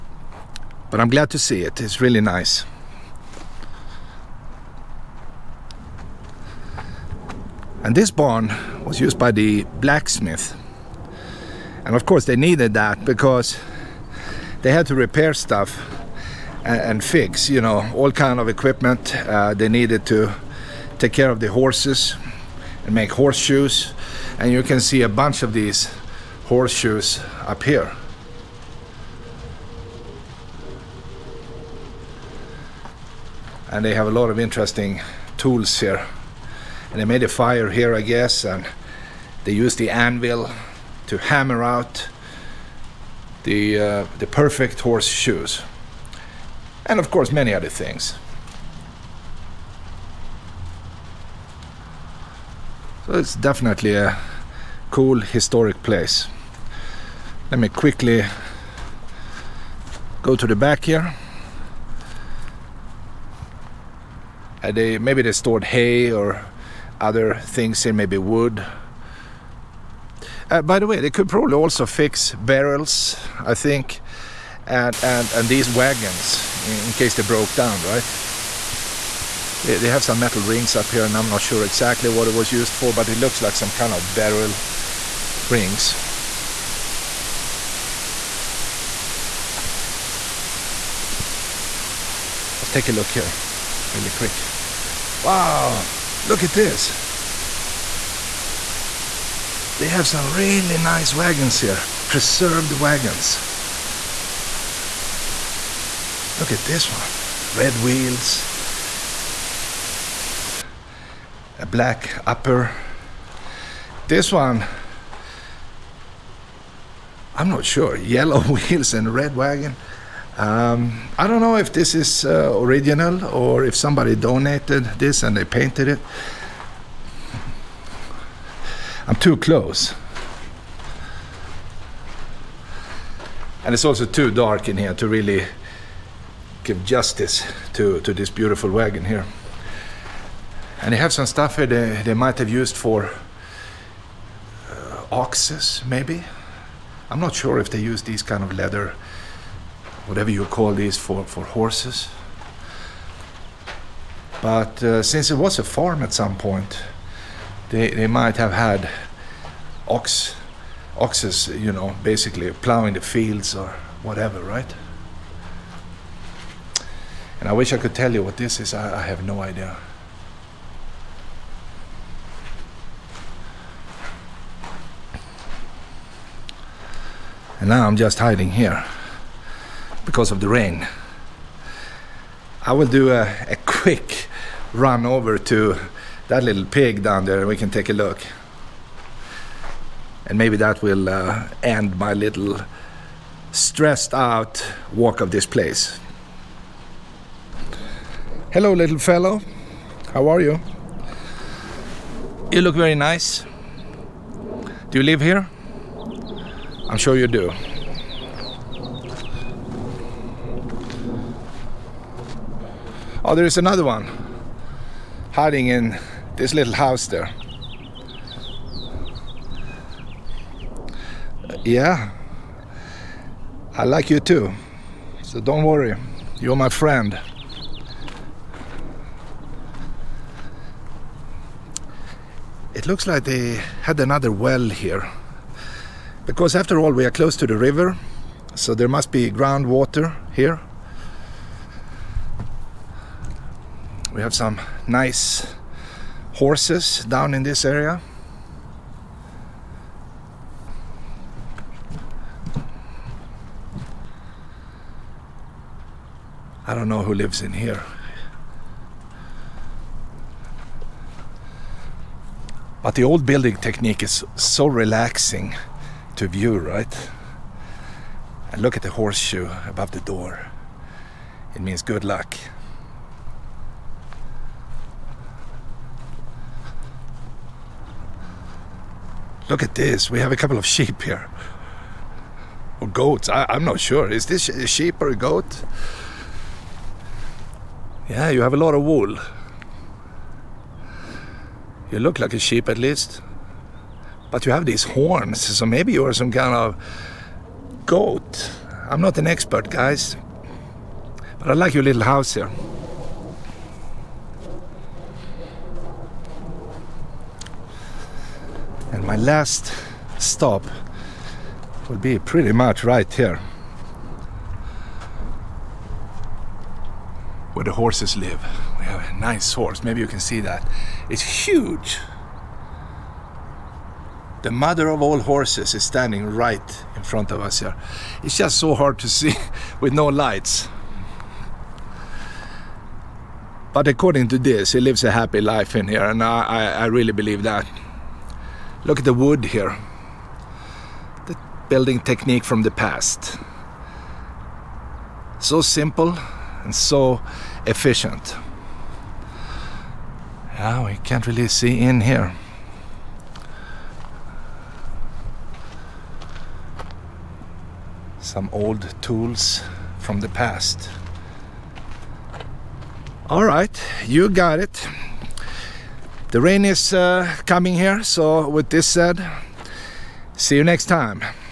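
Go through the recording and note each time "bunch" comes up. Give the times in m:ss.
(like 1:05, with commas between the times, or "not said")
0:25.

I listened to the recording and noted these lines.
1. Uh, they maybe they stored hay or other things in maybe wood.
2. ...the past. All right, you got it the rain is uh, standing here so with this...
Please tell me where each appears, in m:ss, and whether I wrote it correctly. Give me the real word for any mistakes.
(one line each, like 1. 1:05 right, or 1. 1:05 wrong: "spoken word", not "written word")
1. 1:04 right
2. 6:00 wrong: "coming", not "standing".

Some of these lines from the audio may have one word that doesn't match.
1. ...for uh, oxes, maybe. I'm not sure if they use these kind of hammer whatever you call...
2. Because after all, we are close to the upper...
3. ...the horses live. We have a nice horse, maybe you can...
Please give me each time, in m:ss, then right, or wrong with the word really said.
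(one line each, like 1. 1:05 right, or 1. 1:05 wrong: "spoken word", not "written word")
1. 2:22 wrong: "leather", not "hammer"
2. 3:56 wrong: "river", not "upper"
3. 5:17 right.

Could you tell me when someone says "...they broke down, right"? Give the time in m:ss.
1:17.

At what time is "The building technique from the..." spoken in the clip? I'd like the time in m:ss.
5:41.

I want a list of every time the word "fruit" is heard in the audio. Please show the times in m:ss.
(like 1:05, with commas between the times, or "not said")
not said.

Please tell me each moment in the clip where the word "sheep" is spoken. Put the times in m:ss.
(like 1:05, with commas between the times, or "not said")
4:40, 4:44, 4:52.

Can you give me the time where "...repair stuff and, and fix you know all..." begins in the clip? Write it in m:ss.
0:14.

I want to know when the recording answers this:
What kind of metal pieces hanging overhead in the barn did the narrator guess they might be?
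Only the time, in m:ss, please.
1:24.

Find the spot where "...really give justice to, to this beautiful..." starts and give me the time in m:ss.
2:15.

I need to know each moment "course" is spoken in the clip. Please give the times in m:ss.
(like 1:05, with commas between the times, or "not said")
0:12, 0:47.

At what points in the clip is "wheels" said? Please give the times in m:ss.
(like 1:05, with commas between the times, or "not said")
1:47, 1:58.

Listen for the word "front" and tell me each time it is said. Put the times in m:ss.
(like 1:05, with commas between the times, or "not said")
5:27.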